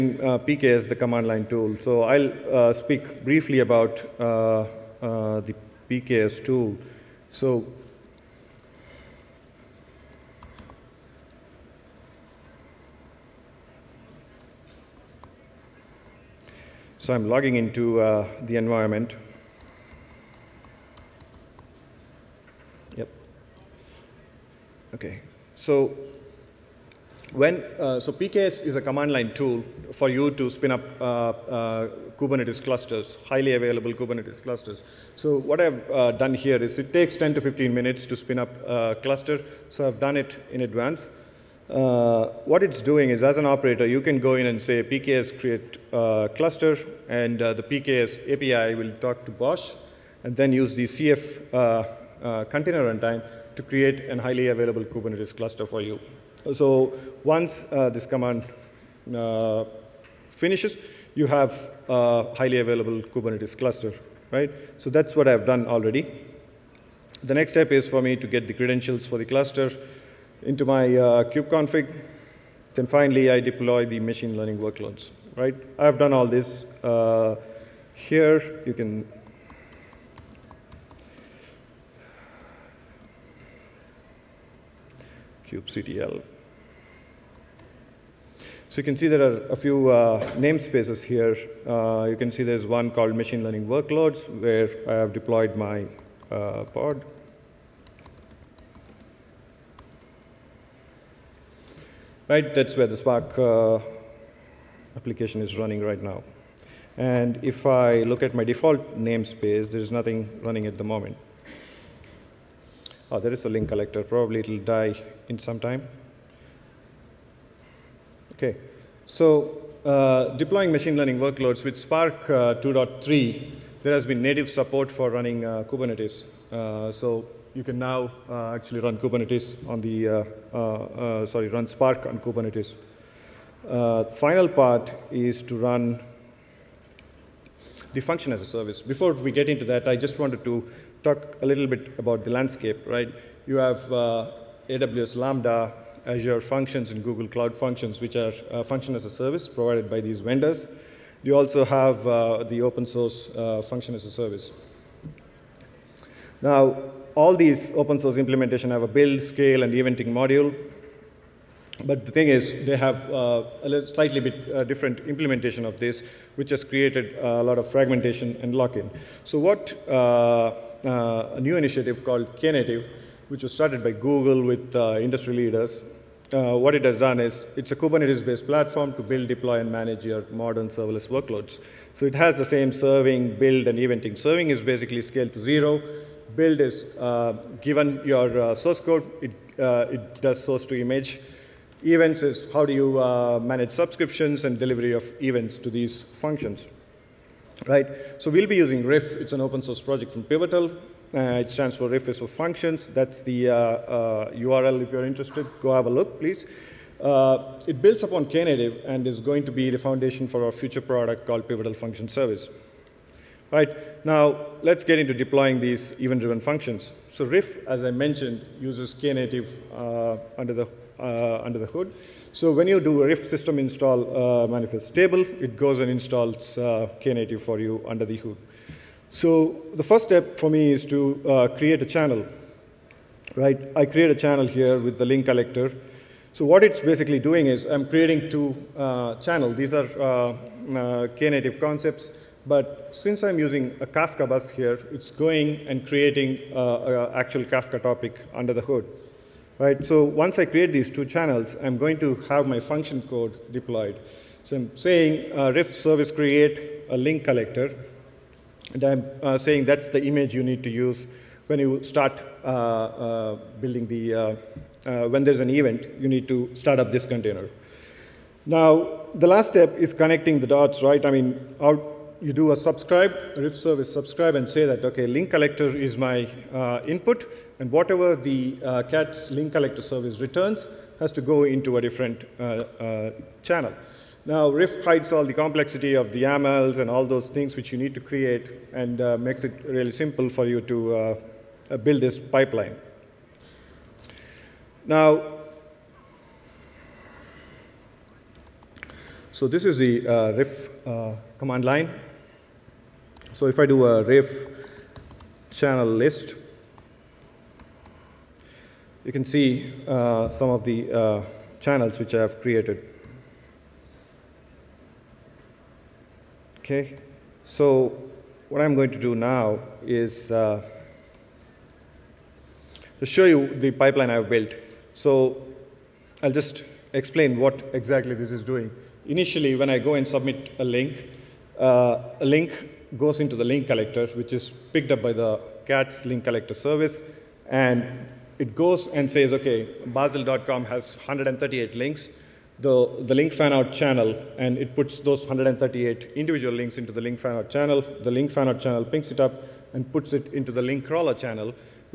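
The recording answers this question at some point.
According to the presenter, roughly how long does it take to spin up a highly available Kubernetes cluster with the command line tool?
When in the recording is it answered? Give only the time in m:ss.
0:37.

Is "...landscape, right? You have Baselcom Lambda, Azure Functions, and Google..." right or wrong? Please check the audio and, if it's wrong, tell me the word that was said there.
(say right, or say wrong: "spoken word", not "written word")
wrong: "AWS", not "Baselcom".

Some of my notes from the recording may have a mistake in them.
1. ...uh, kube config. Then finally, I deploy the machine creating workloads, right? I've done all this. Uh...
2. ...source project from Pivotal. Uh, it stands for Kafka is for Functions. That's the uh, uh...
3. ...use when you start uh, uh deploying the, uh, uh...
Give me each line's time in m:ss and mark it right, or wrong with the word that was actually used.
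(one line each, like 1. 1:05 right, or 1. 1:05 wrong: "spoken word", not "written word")
1. 1:10 wrong: "learning", not "creating"
2. 3:19 wrong: "Riff", not "Kafka"
3. 4:20 wrong: "building", not "deploying".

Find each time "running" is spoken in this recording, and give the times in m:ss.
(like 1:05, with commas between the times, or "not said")
1:45, 1:50, 2:05.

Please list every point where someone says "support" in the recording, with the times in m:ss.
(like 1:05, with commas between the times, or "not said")
2:04.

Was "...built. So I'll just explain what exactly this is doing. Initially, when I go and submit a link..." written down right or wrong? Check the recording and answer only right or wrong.
right.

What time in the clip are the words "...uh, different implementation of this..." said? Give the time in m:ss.
2:44.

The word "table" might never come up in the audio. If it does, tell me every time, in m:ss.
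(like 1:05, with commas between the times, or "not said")
3:44.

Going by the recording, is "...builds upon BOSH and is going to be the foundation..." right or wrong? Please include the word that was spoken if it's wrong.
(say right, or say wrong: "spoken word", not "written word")
wrong: "Knative", not "BOSH".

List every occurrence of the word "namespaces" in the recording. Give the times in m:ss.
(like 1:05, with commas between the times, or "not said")
1:30, 1:48.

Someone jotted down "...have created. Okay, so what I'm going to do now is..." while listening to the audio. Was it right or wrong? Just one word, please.
right.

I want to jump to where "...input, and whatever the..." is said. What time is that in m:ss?
4:36.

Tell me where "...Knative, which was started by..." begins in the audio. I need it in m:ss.
2:52.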